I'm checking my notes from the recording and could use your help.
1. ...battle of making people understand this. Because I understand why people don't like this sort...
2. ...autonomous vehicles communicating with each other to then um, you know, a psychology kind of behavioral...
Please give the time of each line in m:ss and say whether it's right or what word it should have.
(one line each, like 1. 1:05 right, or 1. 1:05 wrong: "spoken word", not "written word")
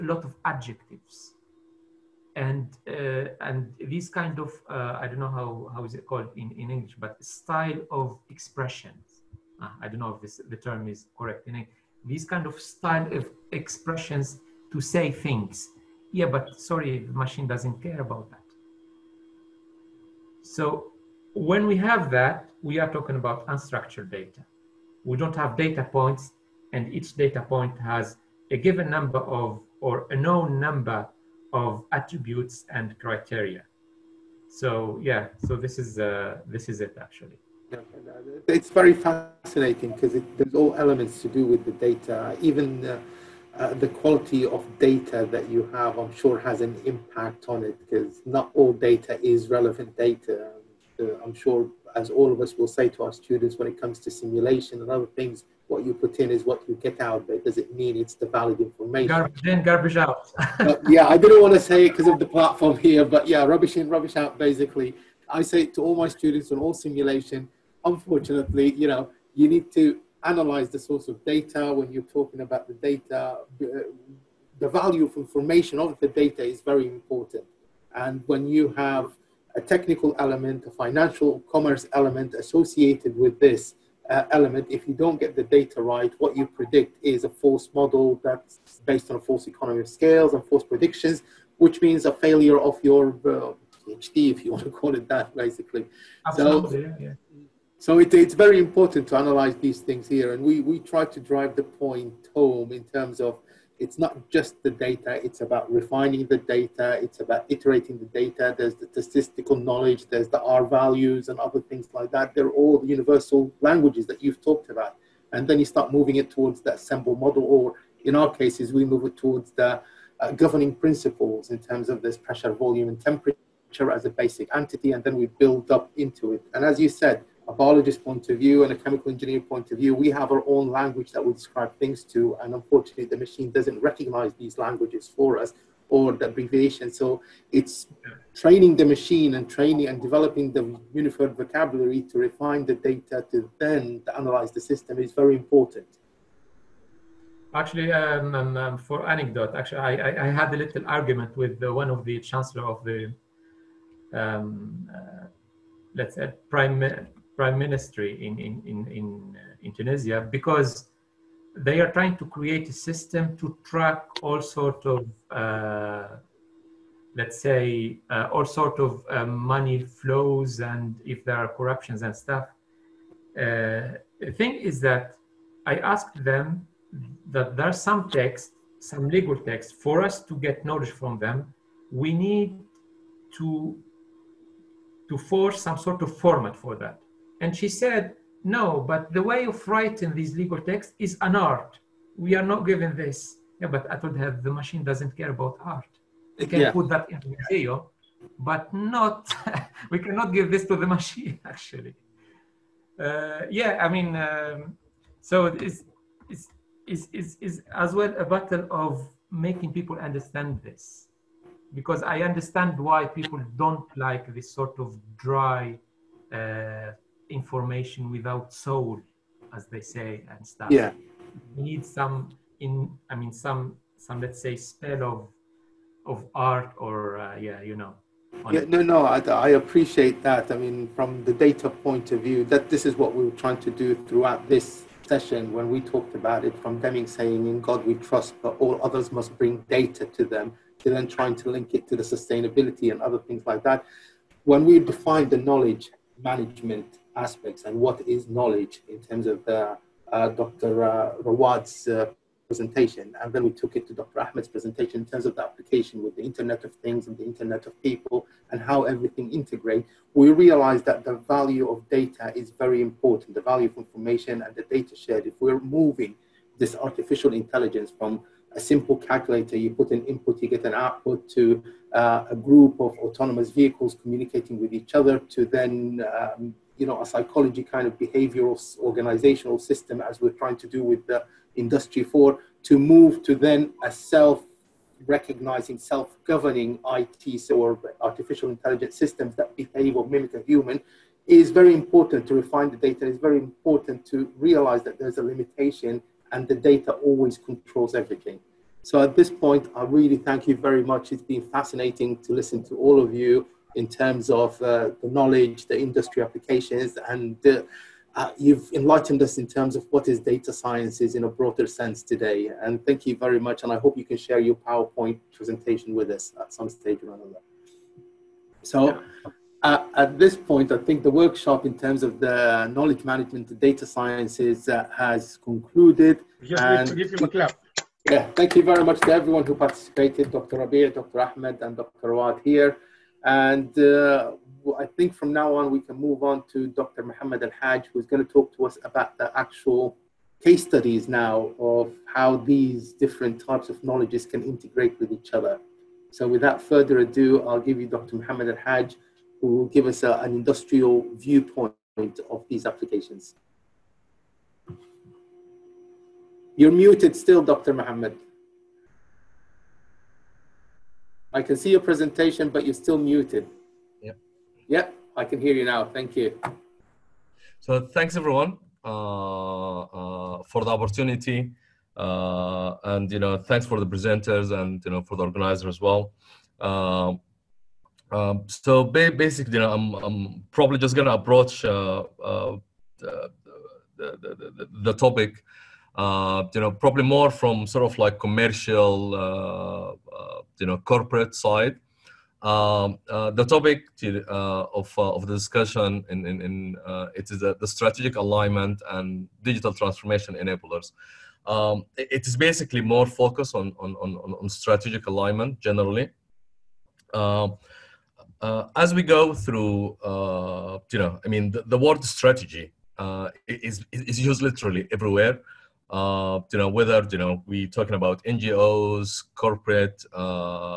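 1. 3:28 right
2. 4:32 right.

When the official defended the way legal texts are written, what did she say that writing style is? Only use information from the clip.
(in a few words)
an art.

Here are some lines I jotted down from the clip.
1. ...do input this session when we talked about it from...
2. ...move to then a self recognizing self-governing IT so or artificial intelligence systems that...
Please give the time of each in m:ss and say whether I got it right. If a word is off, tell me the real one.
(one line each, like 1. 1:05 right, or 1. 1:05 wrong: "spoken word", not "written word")
1. 3:53 wrong: "throughout", not "input"
2. 4:42 right.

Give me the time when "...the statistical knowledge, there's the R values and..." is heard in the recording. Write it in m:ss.
1:48.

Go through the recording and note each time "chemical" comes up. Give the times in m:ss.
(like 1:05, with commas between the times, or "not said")
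2:08.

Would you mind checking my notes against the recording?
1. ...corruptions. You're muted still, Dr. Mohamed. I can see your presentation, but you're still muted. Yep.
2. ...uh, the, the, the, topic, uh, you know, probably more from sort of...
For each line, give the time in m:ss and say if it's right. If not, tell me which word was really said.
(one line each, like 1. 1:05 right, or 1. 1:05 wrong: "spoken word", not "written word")
1. 5:52 wrong: "applications", not "corruptions"
2. 6:22 right.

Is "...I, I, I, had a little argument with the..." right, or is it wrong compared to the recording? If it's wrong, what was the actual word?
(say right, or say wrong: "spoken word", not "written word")
right.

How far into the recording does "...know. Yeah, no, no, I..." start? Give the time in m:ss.
3:47.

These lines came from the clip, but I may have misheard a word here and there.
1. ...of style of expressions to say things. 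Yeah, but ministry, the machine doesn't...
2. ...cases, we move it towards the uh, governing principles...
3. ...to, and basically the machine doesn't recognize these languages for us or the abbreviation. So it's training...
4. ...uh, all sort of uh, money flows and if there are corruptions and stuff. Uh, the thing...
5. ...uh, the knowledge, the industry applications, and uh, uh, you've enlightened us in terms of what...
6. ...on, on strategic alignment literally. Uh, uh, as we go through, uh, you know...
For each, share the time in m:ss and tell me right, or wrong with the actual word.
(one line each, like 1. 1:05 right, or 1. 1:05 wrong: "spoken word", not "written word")
1. 0:12 wrong: "sorry", not "ministry"
2. 1:58 right
3. 2:12 wrong: "unfortunately", not "basically"
4. 2:48 right
5. 5:04 right
6. 6:43 wrong: "generally", not "literally".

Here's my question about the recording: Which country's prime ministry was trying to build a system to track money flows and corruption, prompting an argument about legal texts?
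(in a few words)
Tunisia.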